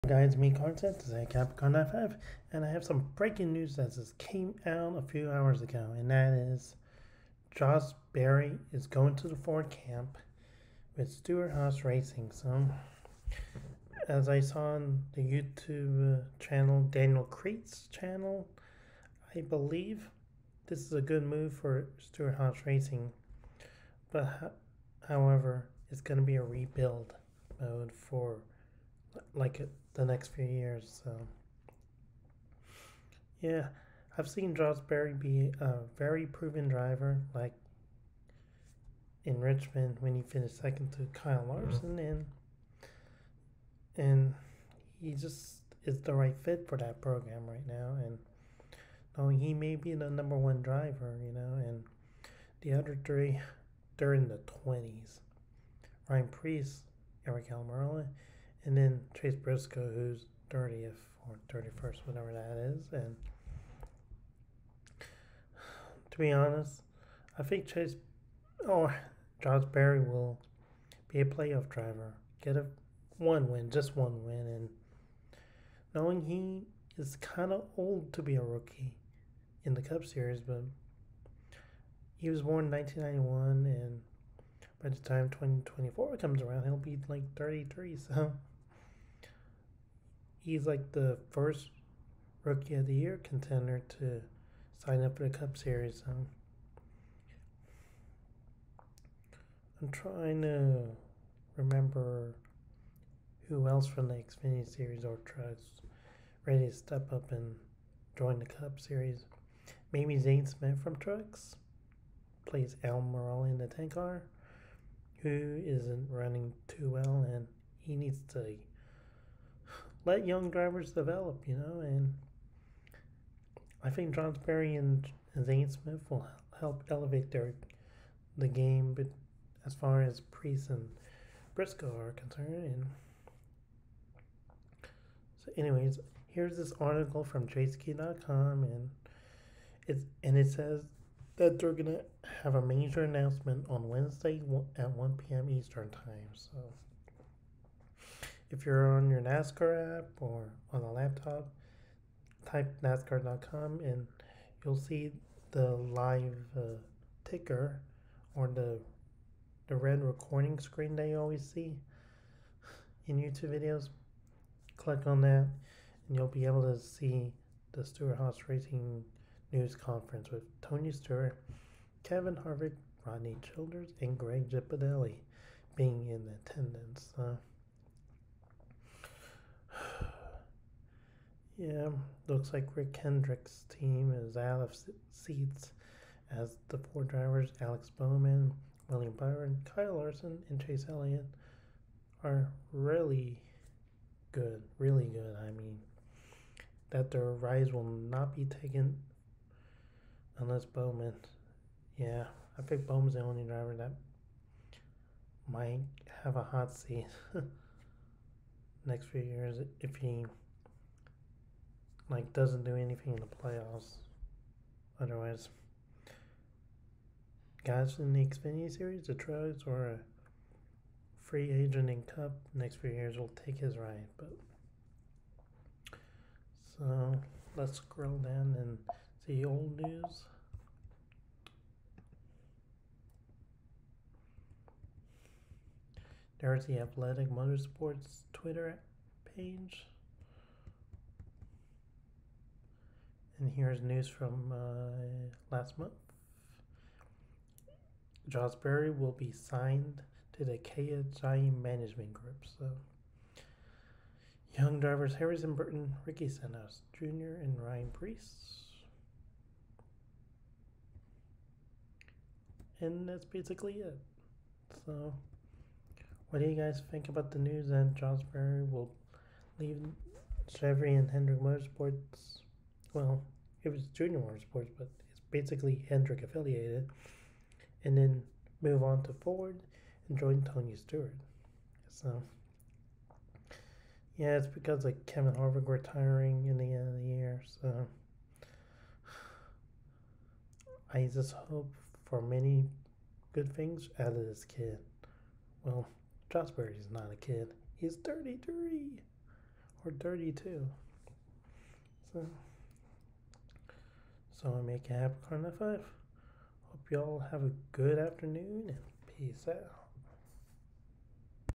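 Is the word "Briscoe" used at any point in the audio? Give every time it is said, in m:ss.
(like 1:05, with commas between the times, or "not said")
0:59, 2:11.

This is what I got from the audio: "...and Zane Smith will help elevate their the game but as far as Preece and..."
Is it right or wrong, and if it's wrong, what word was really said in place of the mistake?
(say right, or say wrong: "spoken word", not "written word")
right.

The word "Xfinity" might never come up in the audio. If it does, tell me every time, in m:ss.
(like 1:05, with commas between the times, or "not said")
1:44, 3:38.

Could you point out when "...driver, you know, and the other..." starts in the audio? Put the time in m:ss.
0:50.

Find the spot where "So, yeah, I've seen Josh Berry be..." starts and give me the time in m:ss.
0:31.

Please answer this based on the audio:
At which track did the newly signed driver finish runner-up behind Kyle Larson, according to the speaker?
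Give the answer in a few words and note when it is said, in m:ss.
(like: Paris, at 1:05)
Richmond, at 0:39.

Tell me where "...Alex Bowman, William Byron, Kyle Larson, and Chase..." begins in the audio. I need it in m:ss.
3:07.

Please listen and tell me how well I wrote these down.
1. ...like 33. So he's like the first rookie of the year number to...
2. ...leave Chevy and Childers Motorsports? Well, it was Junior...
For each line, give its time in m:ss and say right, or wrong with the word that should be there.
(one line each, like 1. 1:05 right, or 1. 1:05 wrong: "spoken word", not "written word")
1. 1:27 wrong: "contender", not "number"
2. 4:29 wrong: "Hendrick", not "Childers".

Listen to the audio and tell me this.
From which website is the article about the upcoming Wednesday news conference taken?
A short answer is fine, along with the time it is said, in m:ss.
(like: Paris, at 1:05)
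Jayski.com, at 2:17.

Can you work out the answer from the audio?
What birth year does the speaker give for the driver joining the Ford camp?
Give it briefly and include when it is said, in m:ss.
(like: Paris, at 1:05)
1991, at 1:22.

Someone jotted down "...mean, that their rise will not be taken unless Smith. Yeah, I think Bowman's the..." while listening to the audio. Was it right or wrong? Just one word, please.
wrong.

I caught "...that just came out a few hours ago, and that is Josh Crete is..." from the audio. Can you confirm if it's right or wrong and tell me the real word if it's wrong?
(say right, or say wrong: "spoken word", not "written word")
wrong: "Berry", not "Crete".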